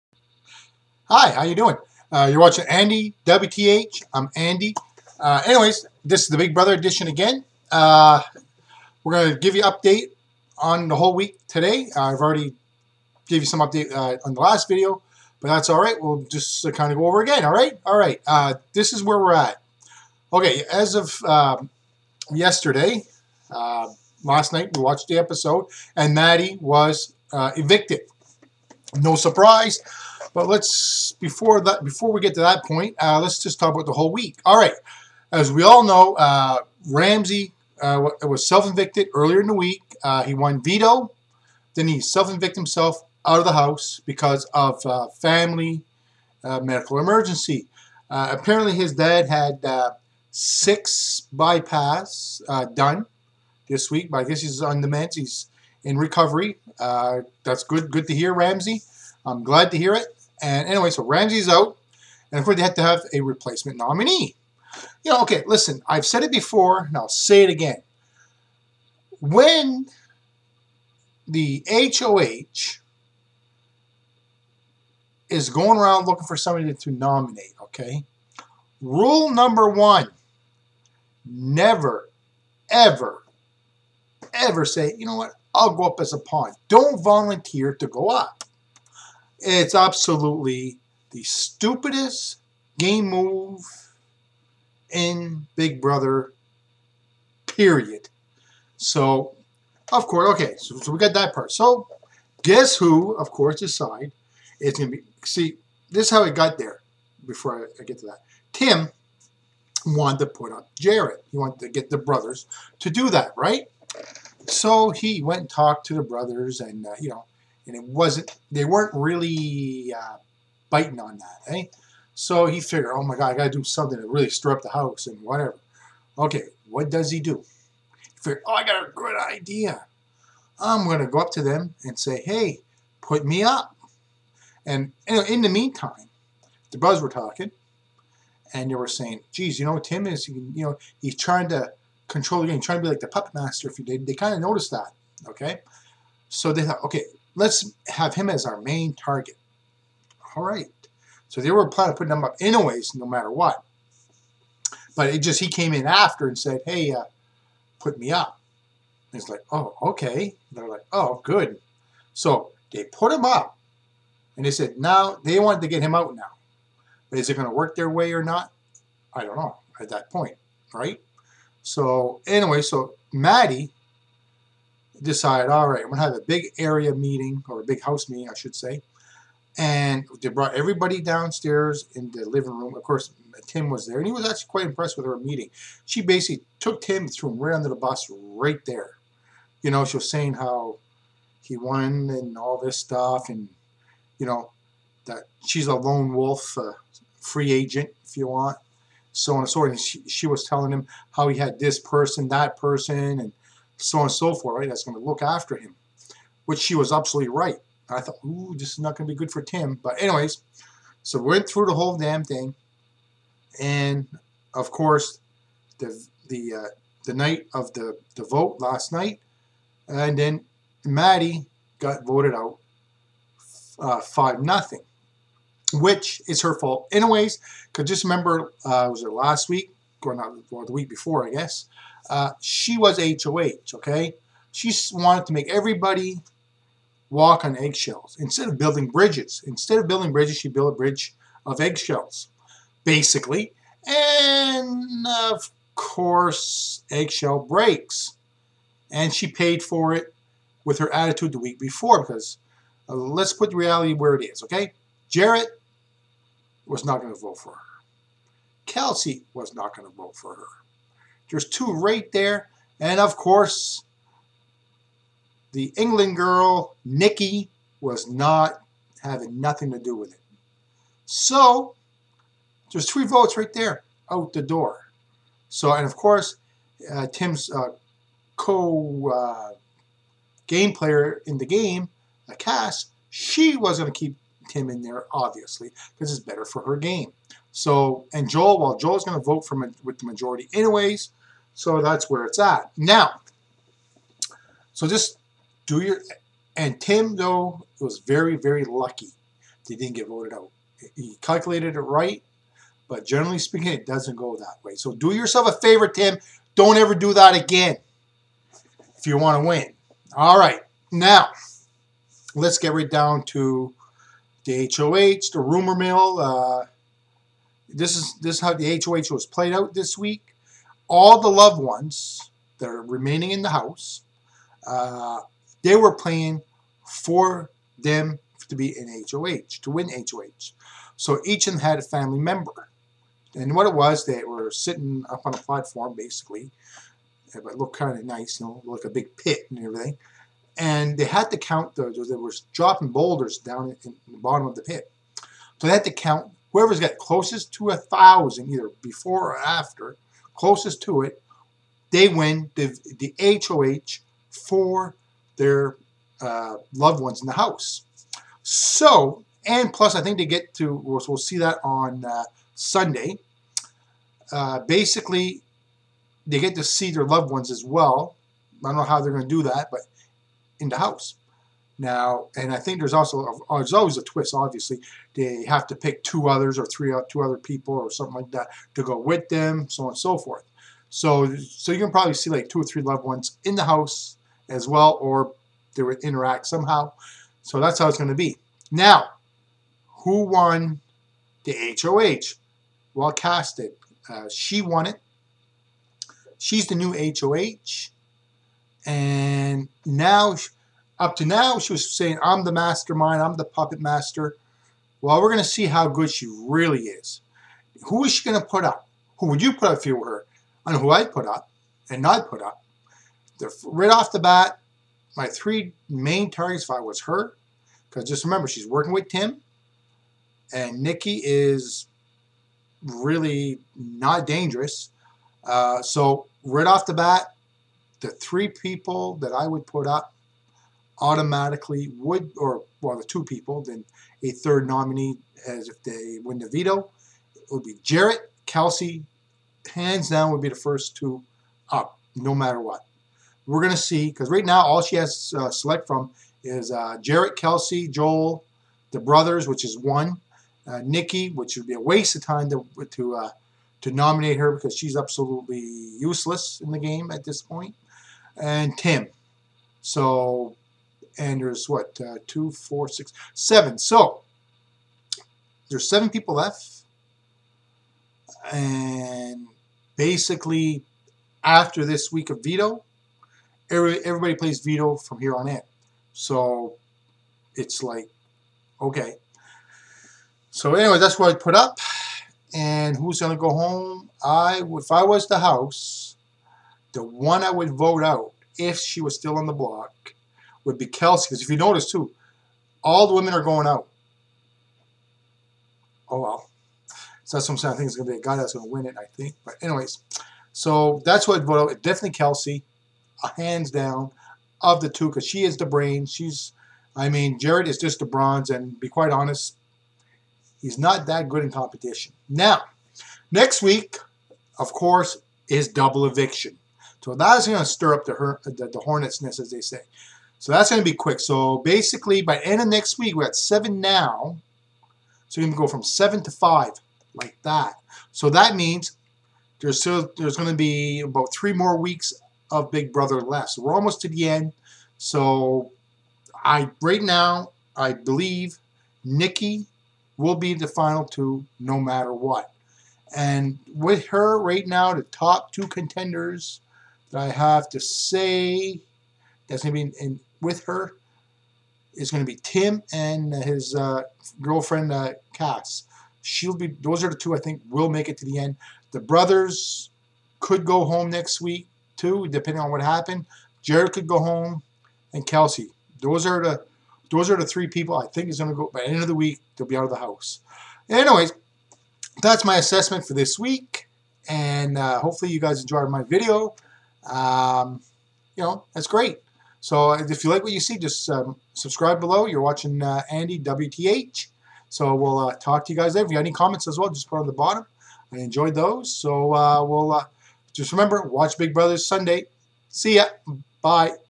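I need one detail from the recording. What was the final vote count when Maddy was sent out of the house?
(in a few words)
5-0.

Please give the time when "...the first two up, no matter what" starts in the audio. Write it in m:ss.
7:20.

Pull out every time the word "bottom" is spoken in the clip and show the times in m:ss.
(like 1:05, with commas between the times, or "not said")
5:44, 9:47.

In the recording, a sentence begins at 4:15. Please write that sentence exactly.
Jarrett was not going to vote for her.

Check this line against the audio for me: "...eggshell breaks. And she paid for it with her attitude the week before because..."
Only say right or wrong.
right.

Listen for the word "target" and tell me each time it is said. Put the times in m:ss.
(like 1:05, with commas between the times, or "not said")
2:28, 6:56.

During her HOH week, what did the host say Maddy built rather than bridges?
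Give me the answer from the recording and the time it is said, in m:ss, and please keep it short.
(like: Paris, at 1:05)
a bridge of eggshells, at 4:00.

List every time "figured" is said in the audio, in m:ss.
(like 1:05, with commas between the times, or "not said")
2:02, 2:08.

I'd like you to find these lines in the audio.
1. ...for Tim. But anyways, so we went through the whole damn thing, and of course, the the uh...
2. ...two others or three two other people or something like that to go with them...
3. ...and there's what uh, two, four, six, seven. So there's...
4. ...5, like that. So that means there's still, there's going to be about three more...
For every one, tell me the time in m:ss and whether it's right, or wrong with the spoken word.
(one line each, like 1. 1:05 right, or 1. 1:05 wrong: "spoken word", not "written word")
1. 3:29 right
2. 6:16 right
3. 7:41 right
4. 8:46 right.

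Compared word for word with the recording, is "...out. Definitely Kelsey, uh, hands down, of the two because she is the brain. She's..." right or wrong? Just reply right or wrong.
right.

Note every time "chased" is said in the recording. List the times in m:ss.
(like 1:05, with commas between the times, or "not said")
not said.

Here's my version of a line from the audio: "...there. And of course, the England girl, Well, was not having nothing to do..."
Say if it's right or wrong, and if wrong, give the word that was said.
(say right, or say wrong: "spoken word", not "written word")
wrong: "Nikki", not "Well".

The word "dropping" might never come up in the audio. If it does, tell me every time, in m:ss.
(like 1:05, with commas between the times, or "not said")
5:42.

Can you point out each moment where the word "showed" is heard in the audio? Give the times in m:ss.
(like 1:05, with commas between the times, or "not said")
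not said.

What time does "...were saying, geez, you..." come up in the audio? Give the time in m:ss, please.
2:18.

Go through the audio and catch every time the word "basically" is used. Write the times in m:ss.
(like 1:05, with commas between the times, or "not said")
3:06, 4:02, 5:35, 6:04, 7:49, 8:41.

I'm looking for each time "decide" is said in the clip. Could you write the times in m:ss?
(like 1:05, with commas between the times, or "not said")
1:43, 2:55.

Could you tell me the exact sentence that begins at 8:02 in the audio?
And who's going to go home?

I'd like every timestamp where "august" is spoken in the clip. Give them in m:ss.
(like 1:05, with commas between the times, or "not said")
not said.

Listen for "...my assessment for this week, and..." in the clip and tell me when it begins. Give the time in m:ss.
9:32.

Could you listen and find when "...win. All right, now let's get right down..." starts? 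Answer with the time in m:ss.
5:09.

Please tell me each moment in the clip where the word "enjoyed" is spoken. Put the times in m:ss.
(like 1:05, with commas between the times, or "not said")
9:35, 9:48.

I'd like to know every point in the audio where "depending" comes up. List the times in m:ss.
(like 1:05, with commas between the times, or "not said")
9:22.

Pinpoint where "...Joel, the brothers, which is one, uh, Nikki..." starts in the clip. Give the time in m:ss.
7:27.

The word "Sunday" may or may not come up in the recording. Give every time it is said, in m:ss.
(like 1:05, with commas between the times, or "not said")
6:02, 9:51.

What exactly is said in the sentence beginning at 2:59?
And they brought everybody downstairs in the living room.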